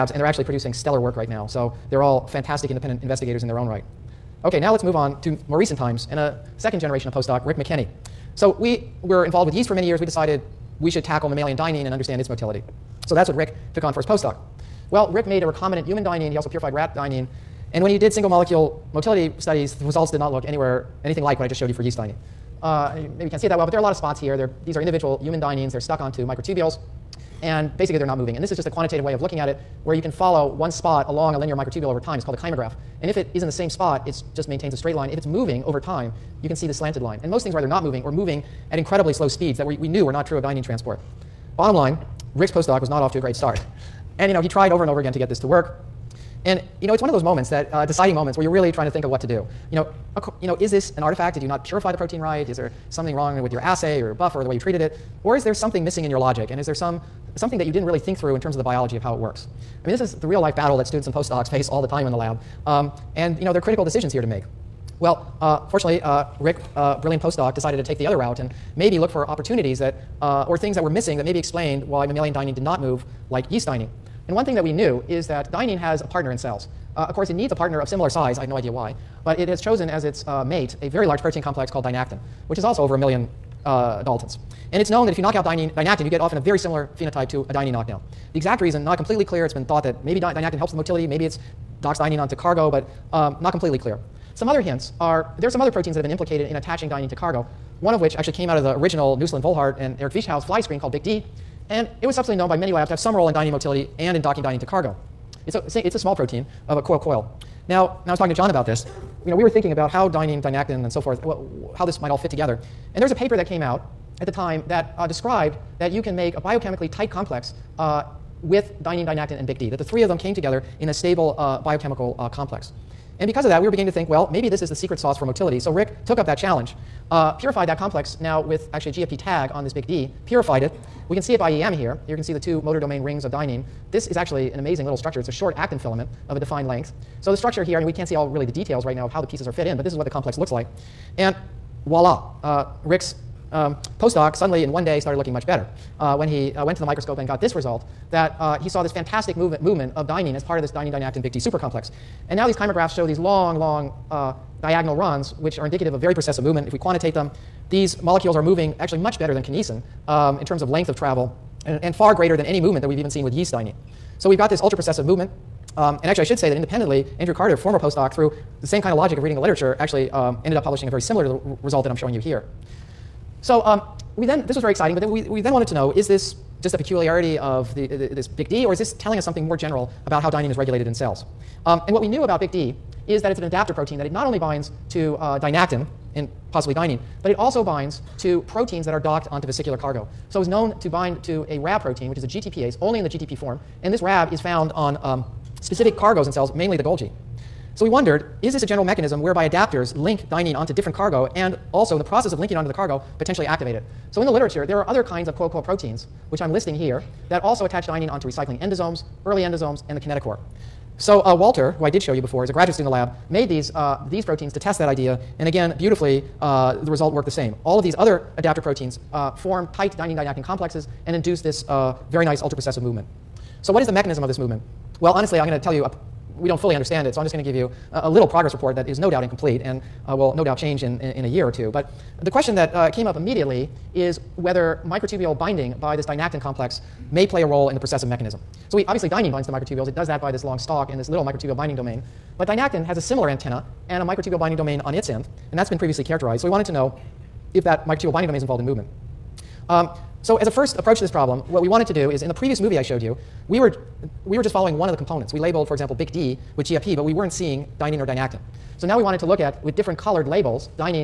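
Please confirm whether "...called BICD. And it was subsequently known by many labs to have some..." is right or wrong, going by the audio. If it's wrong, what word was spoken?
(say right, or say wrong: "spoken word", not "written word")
right.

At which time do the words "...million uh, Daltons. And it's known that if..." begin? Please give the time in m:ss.
1:22.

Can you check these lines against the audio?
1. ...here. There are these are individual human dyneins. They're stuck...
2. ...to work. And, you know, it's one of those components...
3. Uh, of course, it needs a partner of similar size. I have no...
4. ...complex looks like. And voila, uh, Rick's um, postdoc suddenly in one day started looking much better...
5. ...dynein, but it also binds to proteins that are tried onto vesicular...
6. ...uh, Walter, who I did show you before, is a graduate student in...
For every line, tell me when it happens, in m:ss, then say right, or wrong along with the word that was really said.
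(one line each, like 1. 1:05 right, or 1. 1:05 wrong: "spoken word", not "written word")
1. 0:24 right
2. 0:45 wrong: "moments", not "components"
3. 1:16 right
4. 2:20 right
5. 3:06 wrong: "docked", not "tried"
6. 3:31 right.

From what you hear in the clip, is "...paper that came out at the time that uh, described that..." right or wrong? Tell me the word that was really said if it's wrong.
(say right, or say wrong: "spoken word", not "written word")
right.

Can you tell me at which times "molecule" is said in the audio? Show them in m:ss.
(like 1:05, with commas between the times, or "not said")
0:18, 2:38.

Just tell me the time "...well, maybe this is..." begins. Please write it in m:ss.
2:04.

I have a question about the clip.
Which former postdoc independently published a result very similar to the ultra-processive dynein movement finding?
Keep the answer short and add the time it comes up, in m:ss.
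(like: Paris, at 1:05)
Andrew Carter, at 2:47.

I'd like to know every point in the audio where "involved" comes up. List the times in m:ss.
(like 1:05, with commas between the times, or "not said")
0:09, 4:08.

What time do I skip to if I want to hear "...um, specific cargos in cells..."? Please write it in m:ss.
3:15.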